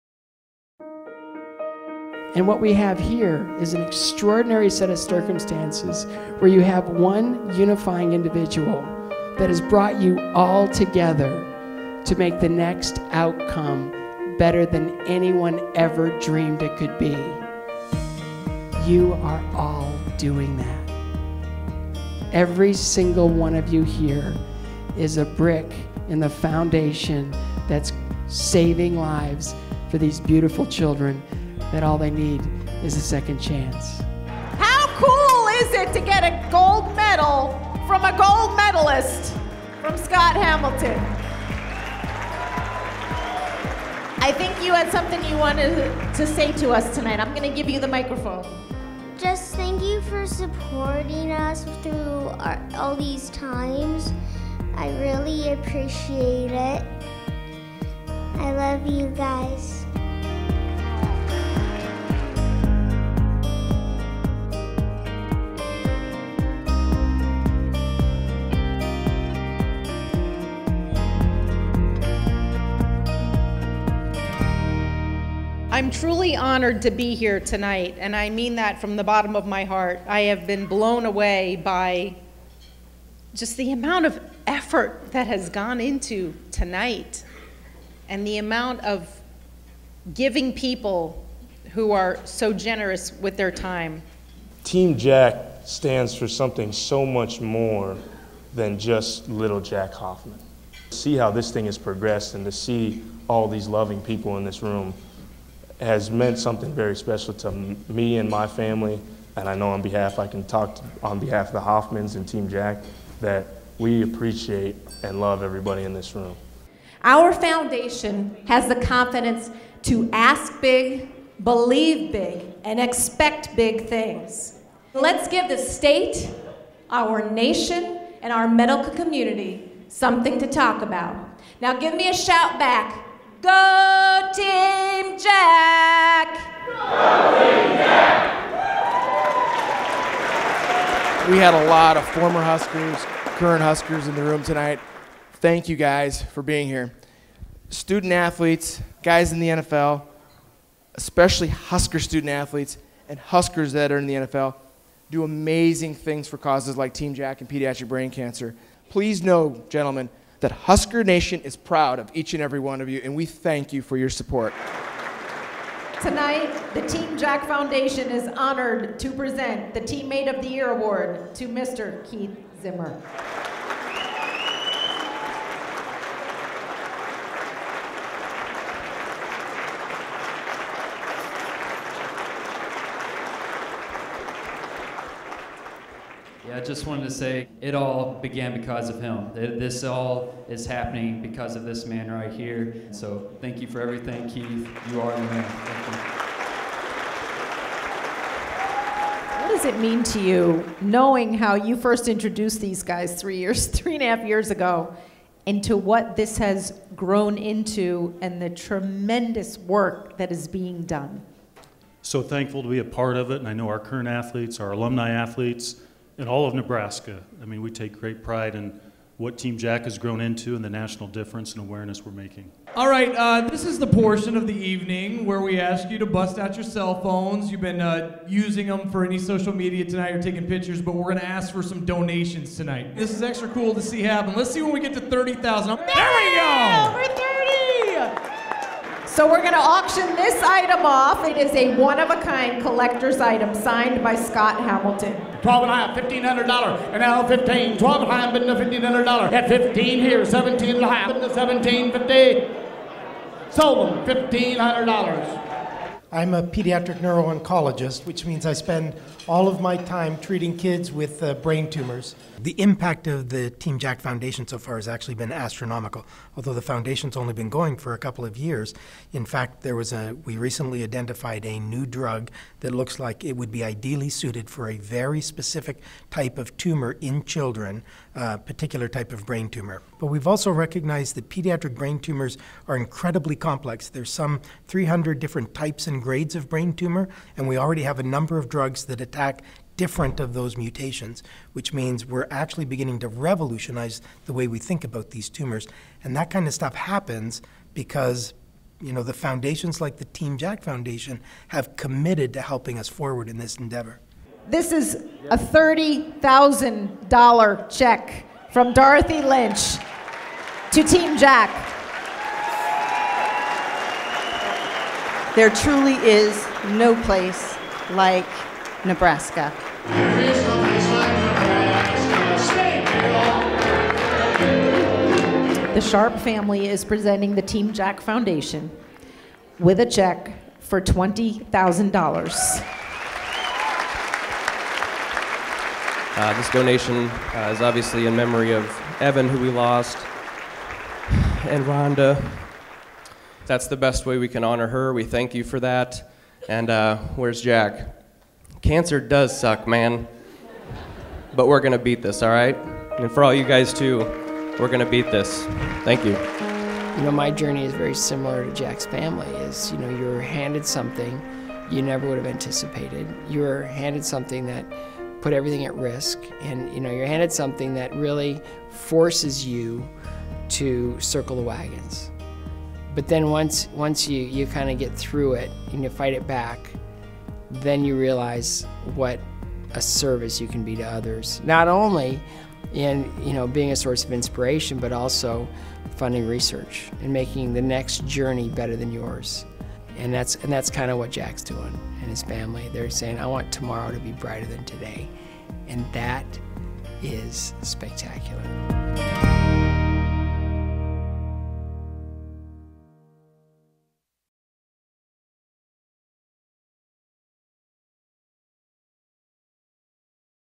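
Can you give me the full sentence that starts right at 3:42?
All right, uh, this is the portion of the evening where we ask you to bust out your cell phones.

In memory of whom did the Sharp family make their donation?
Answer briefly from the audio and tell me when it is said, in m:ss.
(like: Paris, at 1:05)
Evan, at 5:38.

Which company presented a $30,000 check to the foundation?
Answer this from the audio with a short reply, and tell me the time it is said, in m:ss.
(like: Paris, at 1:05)
Dorothy Lynch, at 5:08.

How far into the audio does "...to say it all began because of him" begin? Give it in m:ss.
3:07.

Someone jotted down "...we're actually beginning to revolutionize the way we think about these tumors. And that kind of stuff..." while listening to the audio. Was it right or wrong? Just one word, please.
right.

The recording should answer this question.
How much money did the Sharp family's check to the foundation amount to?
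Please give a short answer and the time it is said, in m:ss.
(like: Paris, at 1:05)
$20,000, at 5:30.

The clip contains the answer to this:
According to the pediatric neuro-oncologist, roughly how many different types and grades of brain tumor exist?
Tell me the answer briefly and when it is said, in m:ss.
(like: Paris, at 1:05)
300, at 4:44.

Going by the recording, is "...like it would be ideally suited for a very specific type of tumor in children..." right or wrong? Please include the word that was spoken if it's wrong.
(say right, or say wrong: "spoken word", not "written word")
right.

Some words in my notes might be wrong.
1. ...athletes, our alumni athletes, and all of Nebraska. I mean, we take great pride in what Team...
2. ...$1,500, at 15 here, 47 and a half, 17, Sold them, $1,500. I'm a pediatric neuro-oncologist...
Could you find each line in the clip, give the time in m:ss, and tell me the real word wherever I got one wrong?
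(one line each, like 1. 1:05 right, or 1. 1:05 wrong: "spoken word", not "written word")
1. 3:34 right
2. 4:08 wrong: "17", not "47".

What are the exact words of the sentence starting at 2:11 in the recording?
Now give me a shout back Go Team Jack!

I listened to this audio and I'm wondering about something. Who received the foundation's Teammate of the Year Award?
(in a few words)
Keith Zimmer.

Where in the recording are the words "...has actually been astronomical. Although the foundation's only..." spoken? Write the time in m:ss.
4:24.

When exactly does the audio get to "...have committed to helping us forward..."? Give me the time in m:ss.
5:01.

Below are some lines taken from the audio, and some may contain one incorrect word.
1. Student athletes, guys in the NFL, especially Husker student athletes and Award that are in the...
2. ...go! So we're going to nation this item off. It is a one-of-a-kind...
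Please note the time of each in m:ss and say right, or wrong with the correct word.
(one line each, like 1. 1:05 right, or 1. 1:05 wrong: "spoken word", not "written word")
1. 2:27 wrong: "Huskers", not "Award"
2. 3:57 wrong: "auction", not "nation".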